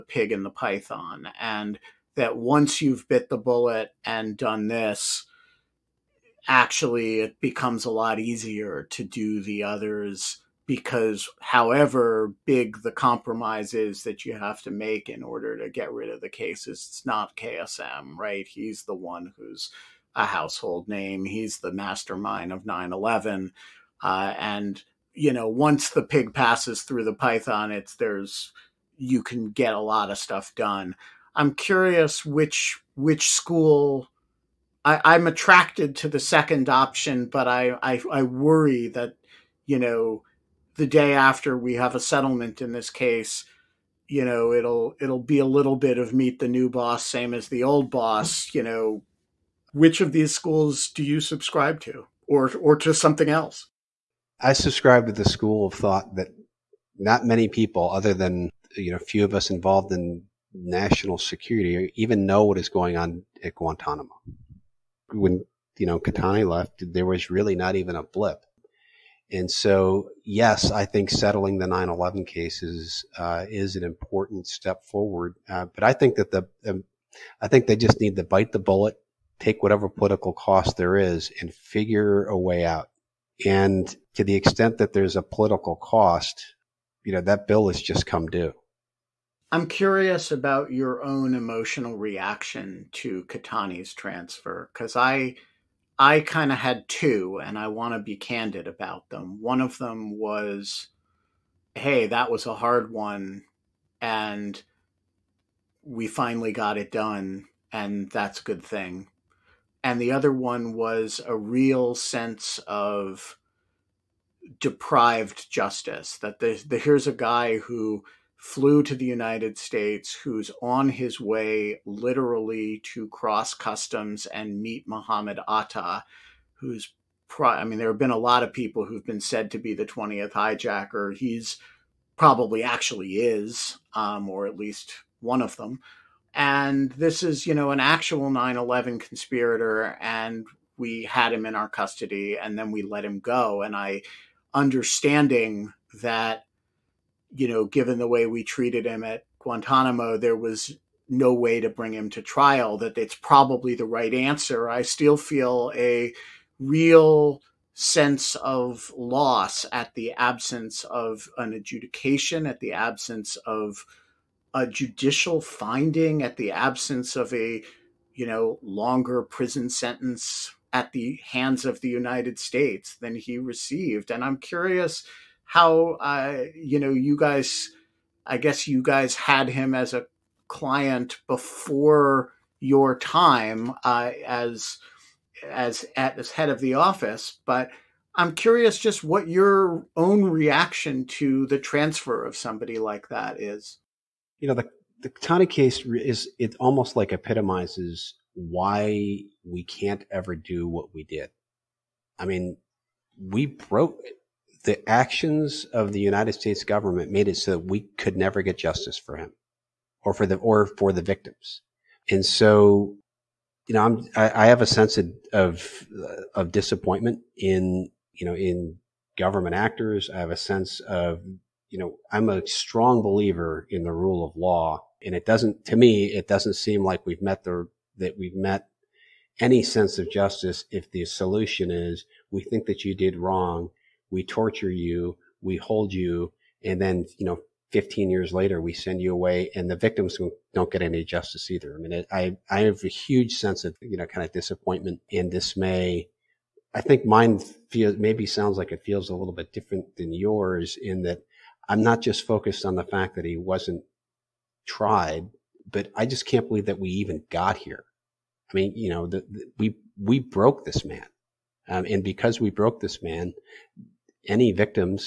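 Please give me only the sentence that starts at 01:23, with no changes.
And to the extent that there's a political cost, you know, that bill has just come due.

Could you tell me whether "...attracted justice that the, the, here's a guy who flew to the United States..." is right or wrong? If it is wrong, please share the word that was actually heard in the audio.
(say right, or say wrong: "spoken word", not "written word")
wrong: "deprived", not "attracted".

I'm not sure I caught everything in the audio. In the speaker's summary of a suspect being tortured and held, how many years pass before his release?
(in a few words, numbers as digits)
15.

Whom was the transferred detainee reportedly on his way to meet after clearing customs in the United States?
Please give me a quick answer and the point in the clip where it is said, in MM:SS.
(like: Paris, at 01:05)
Muhammad Atta, at 02:04.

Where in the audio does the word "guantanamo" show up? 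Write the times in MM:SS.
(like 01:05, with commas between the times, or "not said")
01:03, 02:29.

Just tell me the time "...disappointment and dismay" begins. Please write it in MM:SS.
04:04.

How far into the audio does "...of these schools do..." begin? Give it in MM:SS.
00:50.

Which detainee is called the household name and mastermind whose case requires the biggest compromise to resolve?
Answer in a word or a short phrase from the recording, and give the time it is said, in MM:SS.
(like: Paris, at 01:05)
KSM, at 00:17.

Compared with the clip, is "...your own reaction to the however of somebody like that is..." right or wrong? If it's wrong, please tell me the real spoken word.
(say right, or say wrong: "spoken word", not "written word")
wrong: "transfer", not "however".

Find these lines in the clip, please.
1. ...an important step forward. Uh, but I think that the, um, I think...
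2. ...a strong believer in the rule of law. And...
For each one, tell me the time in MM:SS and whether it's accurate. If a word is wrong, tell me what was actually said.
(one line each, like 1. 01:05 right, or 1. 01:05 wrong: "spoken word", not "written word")
1. 01:13 right
2. 03:42 right.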